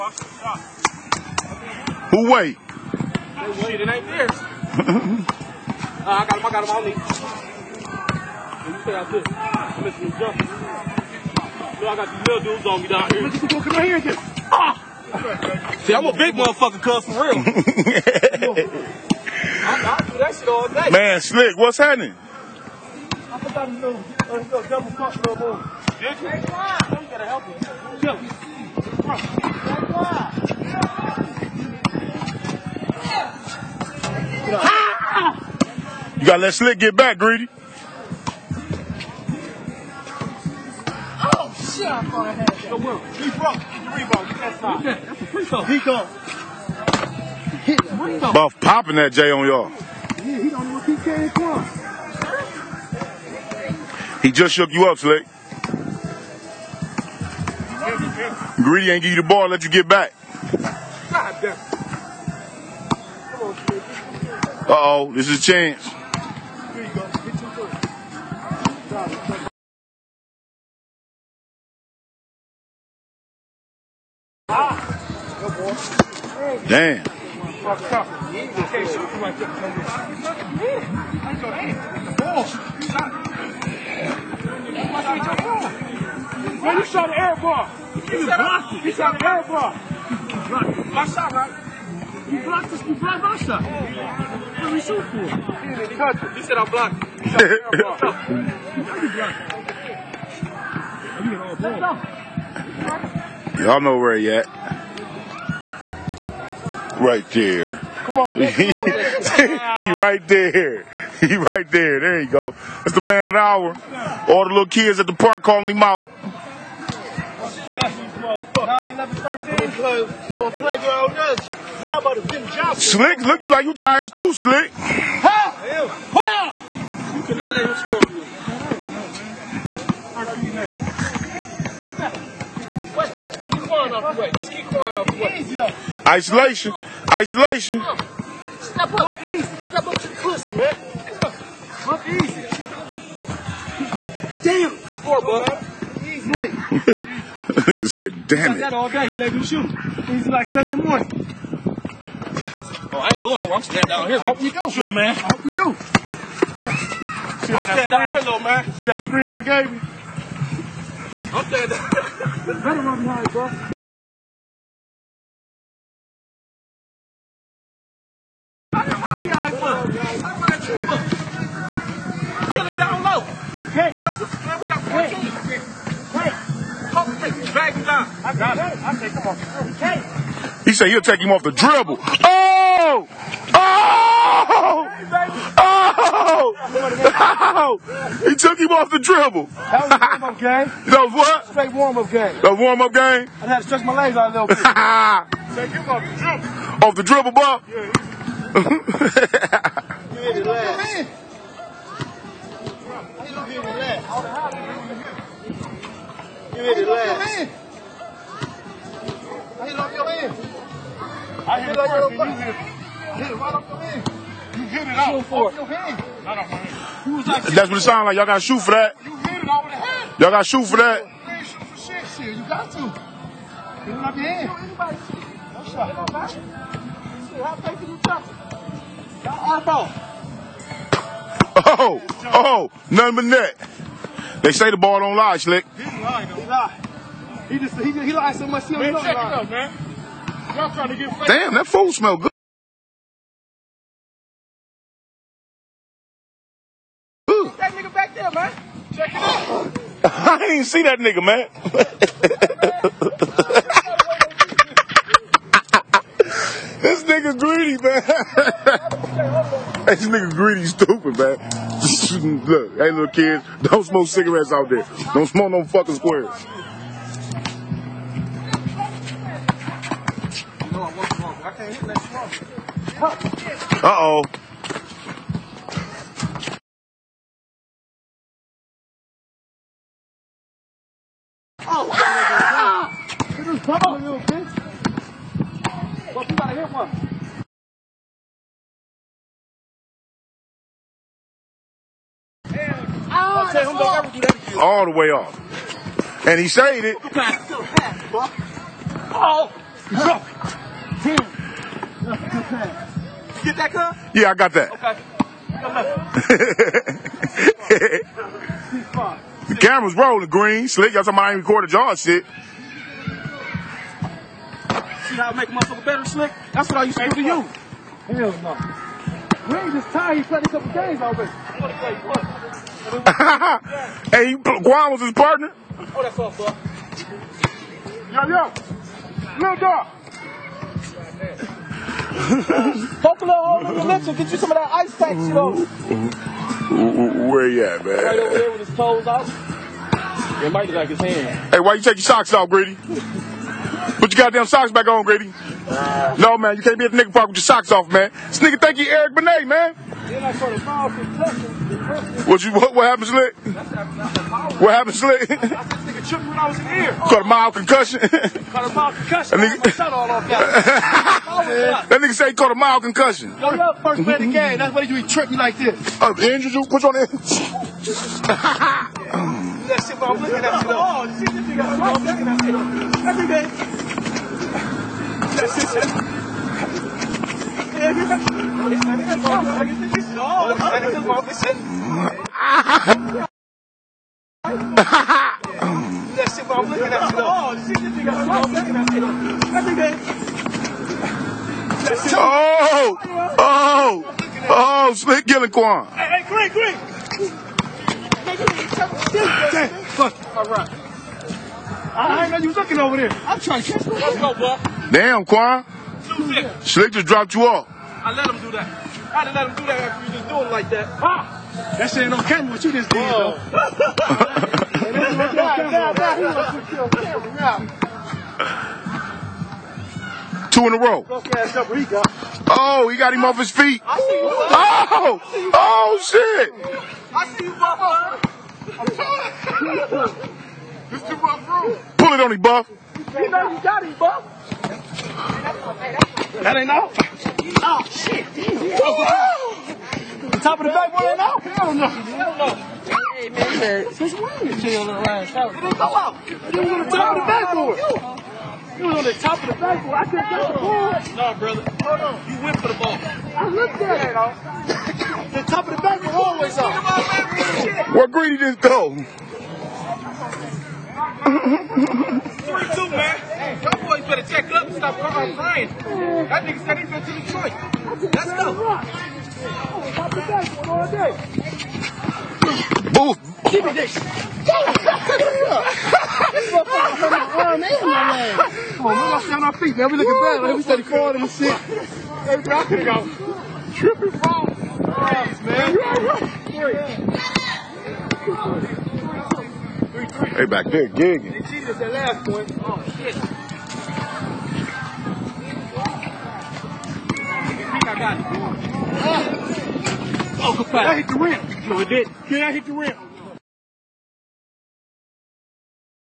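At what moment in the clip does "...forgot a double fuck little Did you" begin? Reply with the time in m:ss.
0:23.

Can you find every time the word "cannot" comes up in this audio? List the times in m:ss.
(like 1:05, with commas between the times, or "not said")
2:07.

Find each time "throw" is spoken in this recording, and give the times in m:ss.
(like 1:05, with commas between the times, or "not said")
0:45.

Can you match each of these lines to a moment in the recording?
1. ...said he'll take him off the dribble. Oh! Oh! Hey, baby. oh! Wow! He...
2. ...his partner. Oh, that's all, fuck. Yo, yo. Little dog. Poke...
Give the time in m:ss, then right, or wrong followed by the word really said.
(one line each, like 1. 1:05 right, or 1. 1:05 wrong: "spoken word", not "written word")
1. 3:00 right
2. 5:25 right.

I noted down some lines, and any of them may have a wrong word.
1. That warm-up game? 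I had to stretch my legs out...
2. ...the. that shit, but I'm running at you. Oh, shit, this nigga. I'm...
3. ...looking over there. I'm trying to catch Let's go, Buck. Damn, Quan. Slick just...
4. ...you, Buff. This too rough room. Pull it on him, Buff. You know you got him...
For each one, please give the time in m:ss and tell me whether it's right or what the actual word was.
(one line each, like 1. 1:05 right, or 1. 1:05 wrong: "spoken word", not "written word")
1. 3:12 right
2. 6:06 wrong: "looking", not "running"
3. 6:42 right
4. 7:07 right.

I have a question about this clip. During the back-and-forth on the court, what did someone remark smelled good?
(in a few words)
food.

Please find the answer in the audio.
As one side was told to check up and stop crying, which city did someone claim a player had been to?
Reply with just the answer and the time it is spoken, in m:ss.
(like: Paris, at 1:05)
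Detroit, at 7:47.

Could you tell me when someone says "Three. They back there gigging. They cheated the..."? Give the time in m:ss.
8:08.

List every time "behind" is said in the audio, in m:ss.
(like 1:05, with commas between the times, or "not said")
2:48.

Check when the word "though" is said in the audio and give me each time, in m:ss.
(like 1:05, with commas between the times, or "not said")
6:53.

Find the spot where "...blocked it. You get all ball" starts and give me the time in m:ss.
1:39.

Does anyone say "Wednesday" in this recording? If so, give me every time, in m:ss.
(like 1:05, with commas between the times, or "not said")
not said.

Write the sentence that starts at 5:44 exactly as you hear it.
Put your goddamn socks back on, Grady.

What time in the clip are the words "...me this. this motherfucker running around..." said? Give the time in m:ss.
7:53.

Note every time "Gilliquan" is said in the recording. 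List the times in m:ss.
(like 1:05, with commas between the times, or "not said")
6:35.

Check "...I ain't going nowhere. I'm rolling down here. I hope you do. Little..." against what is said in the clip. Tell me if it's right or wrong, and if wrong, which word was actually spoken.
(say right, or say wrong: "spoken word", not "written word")
wrong: "standing", not "rolling".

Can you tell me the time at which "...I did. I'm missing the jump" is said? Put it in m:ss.
0:08.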